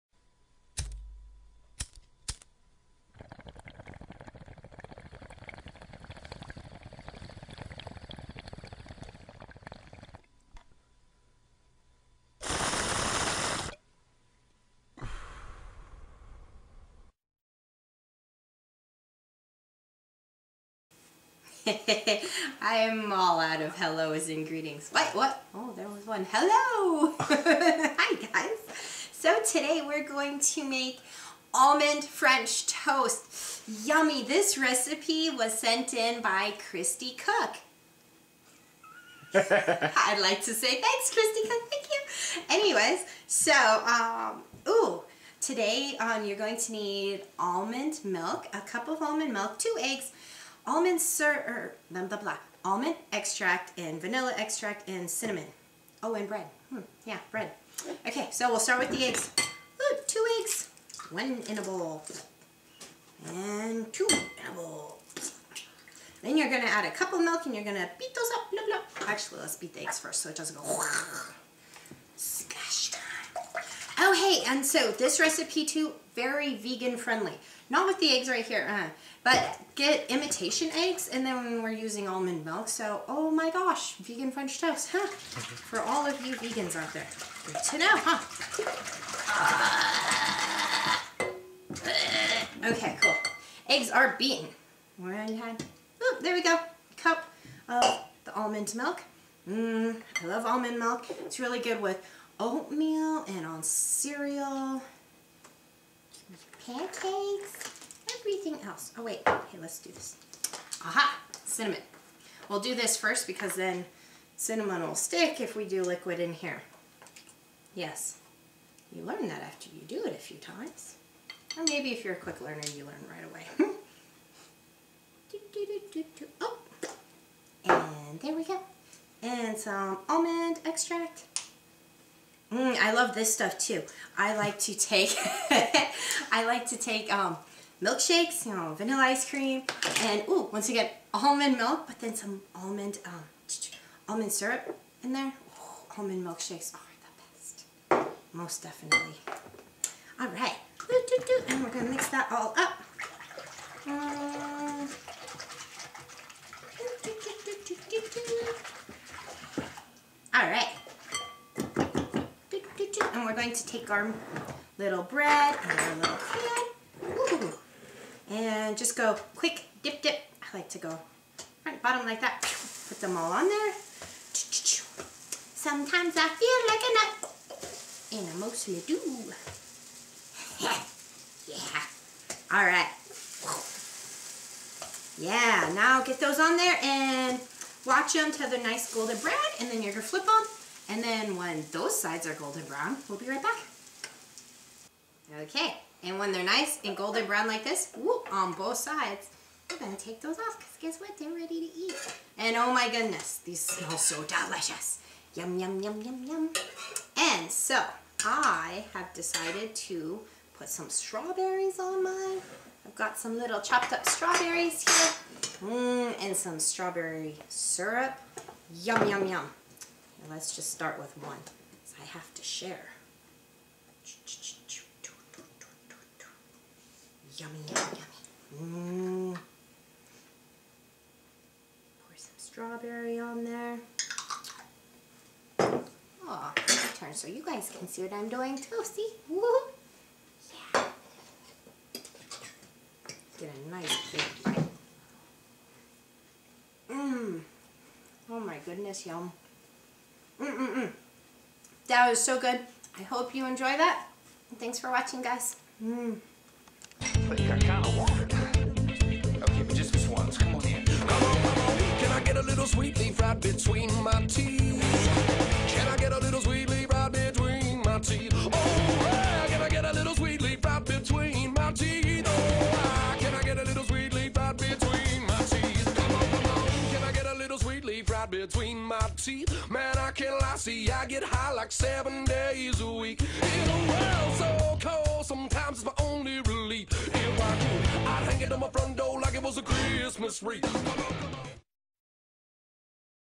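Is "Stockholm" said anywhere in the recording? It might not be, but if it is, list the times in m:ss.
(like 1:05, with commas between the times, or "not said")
not said.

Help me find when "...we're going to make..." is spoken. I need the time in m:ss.
0:29.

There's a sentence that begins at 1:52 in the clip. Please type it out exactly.
We'll do this first because then cinnamon will stick if we do liquid in here.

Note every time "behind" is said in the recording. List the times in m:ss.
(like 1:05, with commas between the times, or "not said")
not said.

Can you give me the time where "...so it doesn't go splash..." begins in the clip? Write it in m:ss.
1:10.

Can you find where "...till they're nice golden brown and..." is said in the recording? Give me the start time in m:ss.
3:08.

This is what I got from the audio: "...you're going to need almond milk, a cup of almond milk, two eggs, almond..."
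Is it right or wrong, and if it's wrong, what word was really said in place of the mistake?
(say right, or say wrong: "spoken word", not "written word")
right.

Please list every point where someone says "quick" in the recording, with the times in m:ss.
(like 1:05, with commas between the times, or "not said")
2:02, 2:49.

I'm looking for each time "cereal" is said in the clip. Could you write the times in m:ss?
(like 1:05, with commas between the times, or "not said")
1:43.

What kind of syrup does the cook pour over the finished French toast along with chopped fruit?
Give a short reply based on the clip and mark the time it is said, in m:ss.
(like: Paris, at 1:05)
strawberry syrup, at 3:36.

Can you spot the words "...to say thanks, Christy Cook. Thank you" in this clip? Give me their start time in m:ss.
0:40.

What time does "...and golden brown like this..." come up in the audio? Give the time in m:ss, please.
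3:16.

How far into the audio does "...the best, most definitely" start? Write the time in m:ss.
2:26.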